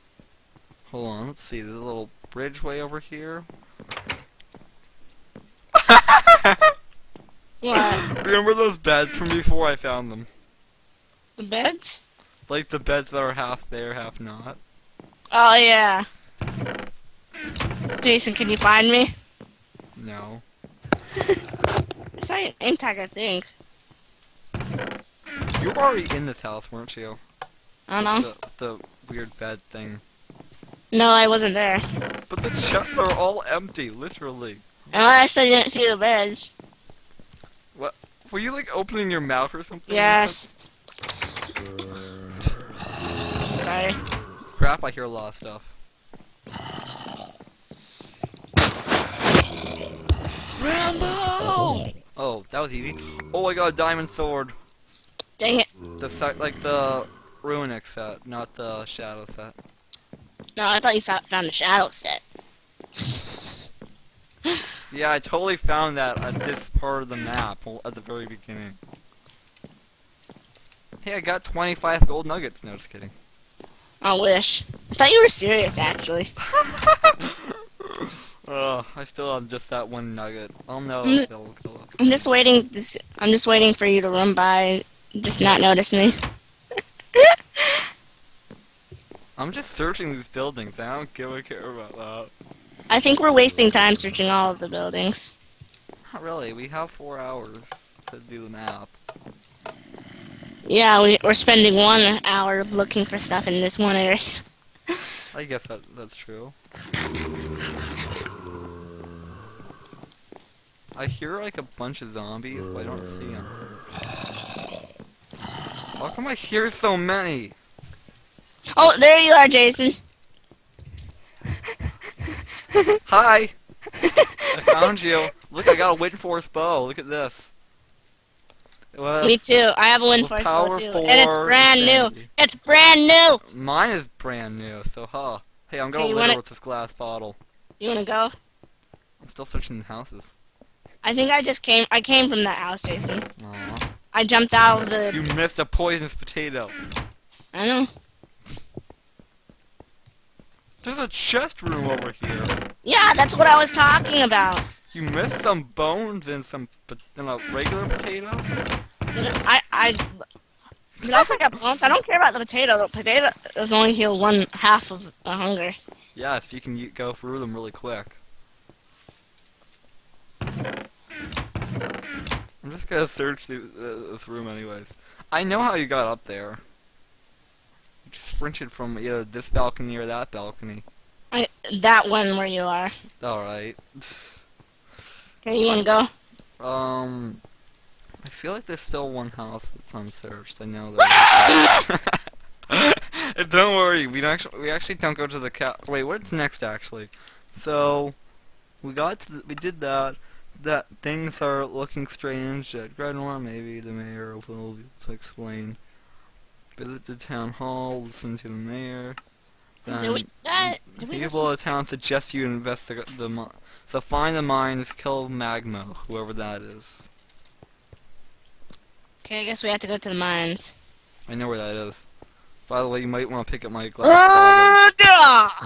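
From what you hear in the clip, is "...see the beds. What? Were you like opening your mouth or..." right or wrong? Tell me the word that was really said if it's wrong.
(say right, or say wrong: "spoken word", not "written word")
right.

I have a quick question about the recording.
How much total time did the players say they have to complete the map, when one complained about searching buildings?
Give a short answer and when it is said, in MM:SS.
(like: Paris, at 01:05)
four hours, at 01:36.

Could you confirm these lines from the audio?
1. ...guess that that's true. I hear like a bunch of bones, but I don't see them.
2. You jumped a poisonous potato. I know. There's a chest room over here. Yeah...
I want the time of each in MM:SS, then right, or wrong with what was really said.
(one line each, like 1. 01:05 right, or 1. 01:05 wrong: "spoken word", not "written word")
1. 01:45 wrong: "zombies", not "bones"
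2. 02:25 wrong: "missed", not "jumped".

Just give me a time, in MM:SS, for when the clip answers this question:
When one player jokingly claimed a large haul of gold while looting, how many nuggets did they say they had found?
01:11.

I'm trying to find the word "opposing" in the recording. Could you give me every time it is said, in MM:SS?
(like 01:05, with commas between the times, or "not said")
not said.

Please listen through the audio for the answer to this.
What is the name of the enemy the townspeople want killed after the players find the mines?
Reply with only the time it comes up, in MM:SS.
03:35.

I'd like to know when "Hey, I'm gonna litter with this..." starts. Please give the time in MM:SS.
02:15.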